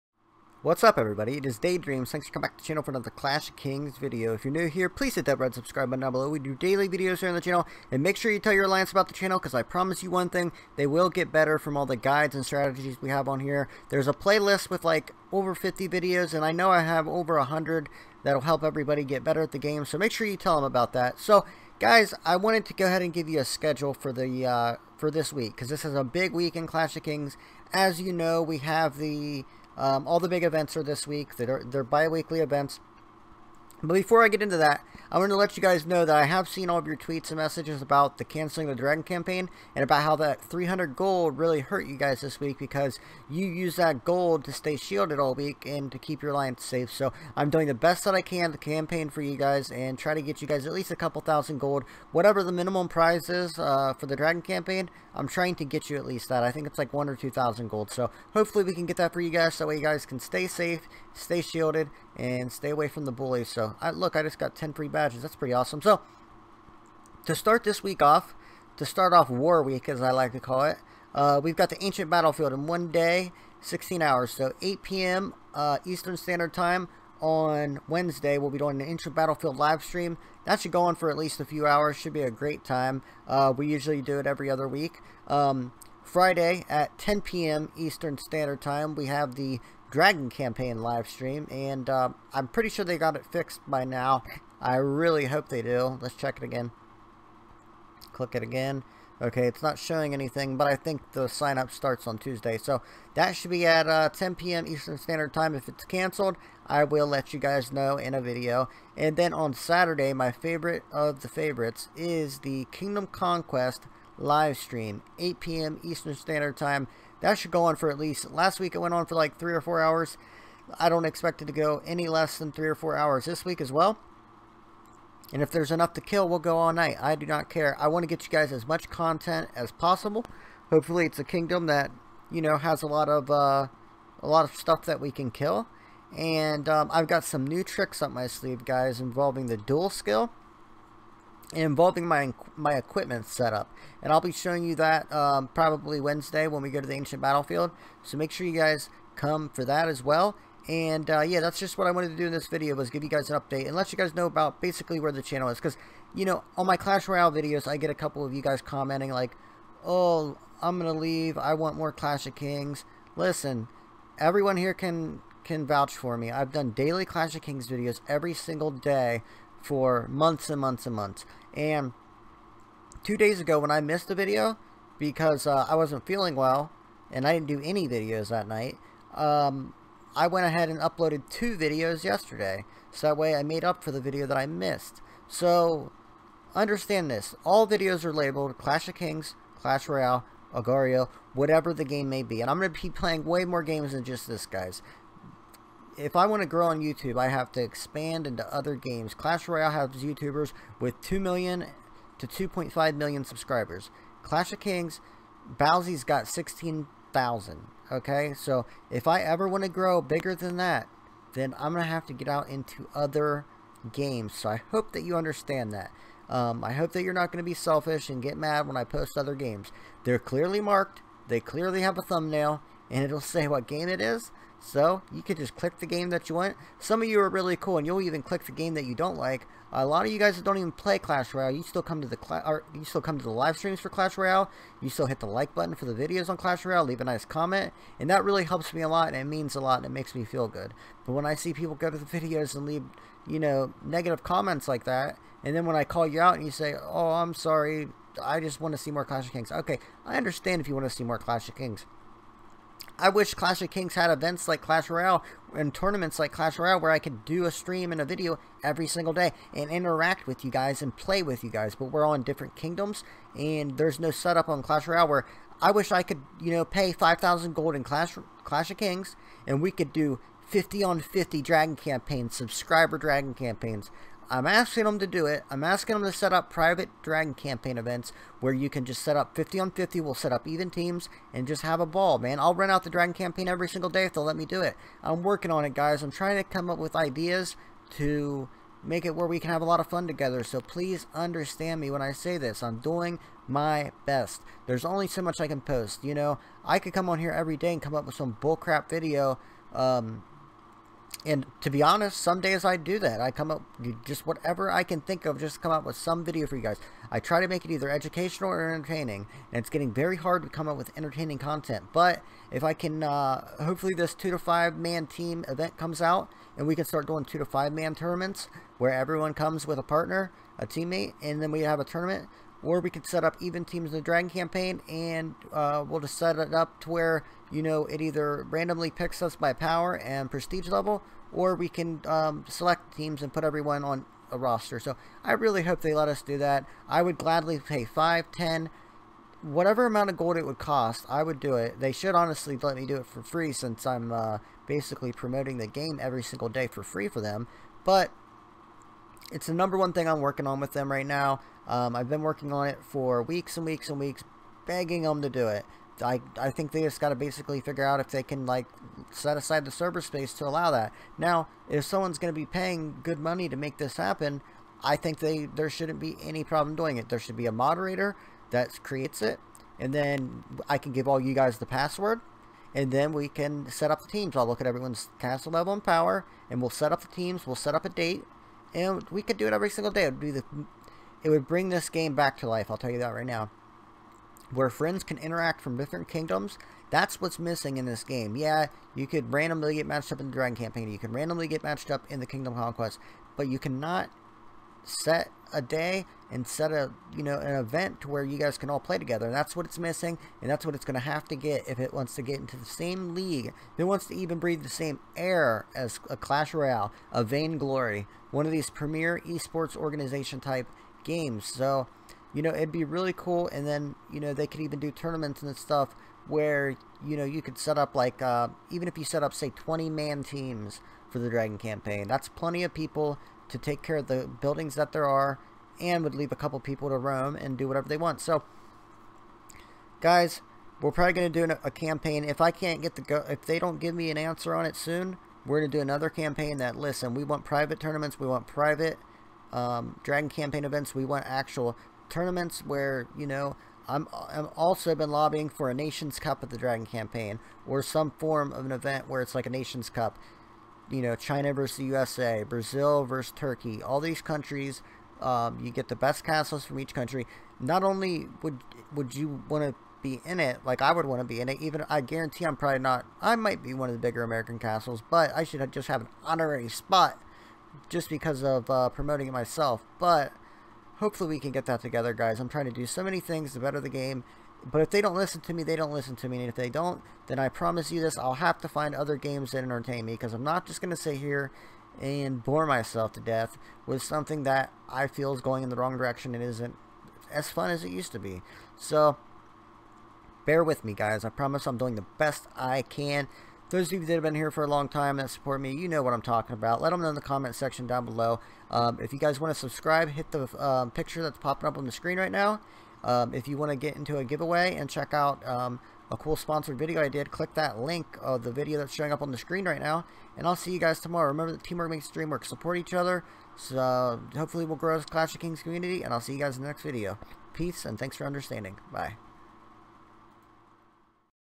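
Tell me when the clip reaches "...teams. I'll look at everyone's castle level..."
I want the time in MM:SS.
06:14.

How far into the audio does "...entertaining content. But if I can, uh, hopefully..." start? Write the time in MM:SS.
05:10.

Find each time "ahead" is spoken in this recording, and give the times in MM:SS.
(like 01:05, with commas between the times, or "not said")
00:22, 03:00.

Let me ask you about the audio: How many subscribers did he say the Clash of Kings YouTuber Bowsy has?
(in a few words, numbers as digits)
16,000.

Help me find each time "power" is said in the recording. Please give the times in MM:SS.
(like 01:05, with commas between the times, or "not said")
05:29, 06:15.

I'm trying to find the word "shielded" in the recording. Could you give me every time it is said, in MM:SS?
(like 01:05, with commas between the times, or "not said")
00:44, 01:01.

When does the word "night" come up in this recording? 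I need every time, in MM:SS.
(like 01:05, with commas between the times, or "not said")
02:06, 02:58.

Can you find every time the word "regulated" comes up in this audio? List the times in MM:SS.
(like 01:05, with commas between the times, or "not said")
not said.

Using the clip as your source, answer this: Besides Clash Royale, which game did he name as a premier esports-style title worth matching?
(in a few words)
Vainglory.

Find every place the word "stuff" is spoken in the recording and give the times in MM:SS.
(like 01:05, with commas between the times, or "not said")
02:14, 06:55.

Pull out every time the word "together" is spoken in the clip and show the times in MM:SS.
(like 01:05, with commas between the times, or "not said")
04:50, 06:38, 07:51.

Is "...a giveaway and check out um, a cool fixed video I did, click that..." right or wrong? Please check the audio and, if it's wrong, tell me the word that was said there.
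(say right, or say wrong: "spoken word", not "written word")
wrong: "sponsored", not "fixed".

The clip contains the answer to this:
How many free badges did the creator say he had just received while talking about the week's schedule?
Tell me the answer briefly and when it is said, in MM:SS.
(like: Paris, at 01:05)
10, at 01:04.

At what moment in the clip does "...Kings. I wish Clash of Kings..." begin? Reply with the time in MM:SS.
04:11.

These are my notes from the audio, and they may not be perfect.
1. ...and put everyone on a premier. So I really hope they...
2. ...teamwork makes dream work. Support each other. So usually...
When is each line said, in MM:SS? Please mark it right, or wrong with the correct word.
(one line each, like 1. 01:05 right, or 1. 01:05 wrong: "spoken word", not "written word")
1. 05:33 wrong: "roster", not "premier"
2. 08:31 wrong: "hopefully", not "usually".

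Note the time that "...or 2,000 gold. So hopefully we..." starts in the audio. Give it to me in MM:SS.
00:57.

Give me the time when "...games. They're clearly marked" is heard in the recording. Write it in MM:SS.
03:39.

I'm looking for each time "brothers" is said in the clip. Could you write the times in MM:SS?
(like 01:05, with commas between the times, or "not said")
not said.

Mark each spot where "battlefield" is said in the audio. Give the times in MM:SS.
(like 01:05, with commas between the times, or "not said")
01:12, 01:19, 02:27.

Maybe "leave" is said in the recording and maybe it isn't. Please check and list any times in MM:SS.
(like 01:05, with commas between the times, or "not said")
02:40, 03:56, 04:02, 07:06.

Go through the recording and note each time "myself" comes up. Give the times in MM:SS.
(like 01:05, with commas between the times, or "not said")
07:49, 08:02.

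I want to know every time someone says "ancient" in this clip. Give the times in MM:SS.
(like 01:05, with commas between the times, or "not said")
01:11, 01:18, 02:26.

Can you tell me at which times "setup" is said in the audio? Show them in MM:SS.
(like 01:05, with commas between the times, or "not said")
02:23, 04:24.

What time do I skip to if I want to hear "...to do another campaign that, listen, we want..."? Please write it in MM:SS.
07:15.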